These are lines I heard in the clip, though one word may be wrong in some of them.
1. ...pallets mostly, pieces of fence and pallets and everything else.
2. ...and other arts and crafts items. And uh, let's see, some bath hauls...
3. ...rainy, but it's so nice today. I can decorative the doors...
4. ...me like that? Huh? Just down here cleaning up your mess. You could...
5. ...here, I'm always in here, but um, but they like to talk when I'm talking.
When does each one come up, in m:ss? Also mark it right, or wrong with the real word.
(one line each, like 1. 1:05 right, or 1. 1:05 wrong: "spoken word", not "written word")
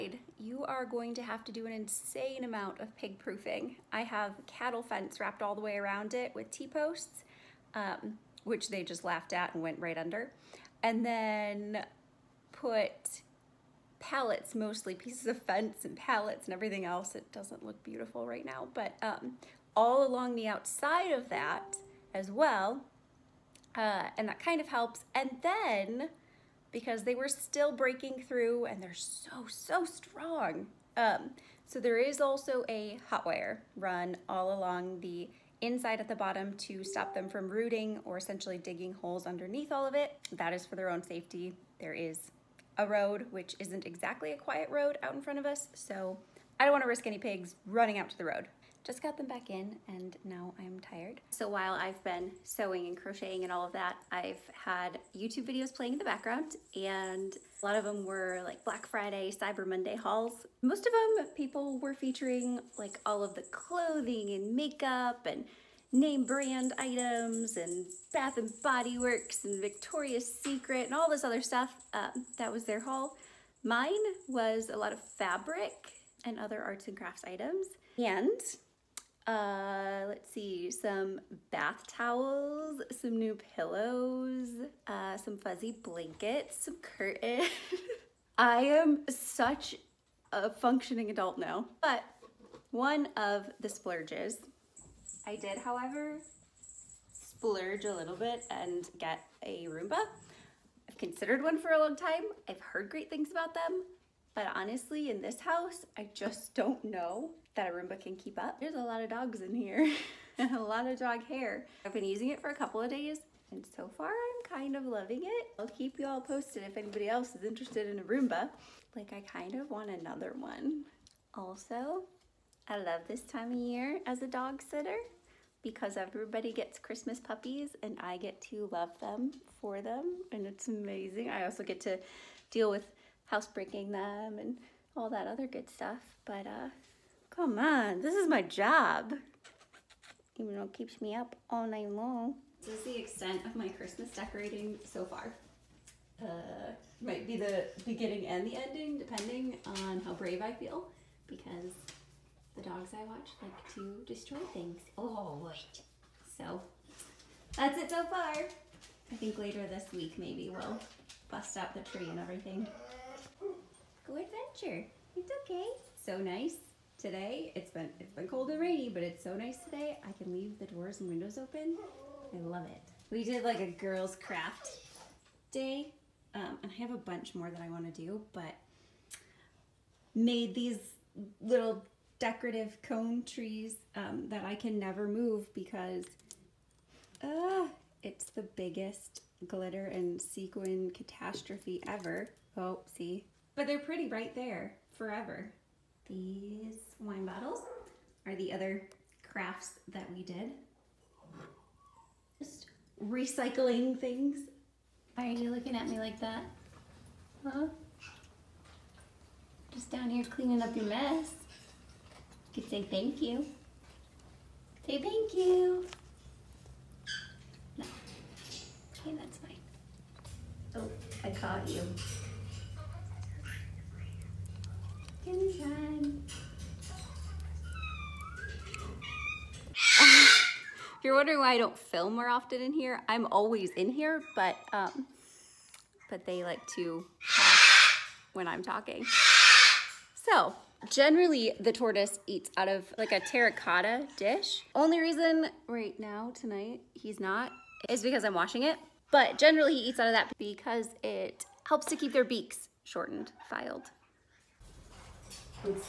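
1. 0:13 right
2. 1:16 wrong: "towels", not "hauls"
3. 2:48 wrong: "leave", not "decorative"
4. 3:25 right
5. 3:52 right.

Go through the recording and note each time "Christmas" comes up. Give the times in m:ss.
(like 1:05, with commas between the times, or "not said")
2:06, 2:23.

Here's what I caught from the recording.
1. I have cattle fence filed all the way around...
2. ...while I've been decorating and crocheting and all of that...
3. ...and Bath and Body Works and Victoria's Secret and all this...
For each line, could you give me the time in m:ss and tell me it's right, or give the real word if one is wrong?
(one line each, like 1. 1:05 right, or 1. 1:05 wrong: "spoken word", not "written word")
1. 0:03 wrong: "wrapped", not "filed"
2. 0:51 wrong: "sewing", not "decorating"
3. 1:07 right.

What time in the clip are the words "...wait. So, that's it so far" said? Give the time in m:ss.
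2:35.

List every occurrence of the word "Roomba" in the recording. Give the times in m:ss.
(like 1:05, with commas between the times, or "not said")
1:39, 1:47, 1:58.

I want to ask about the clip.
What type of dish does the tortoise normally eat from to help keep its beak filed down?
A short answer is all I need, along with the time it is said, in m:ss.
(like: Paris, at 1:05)
terracotta dish, at 4:03.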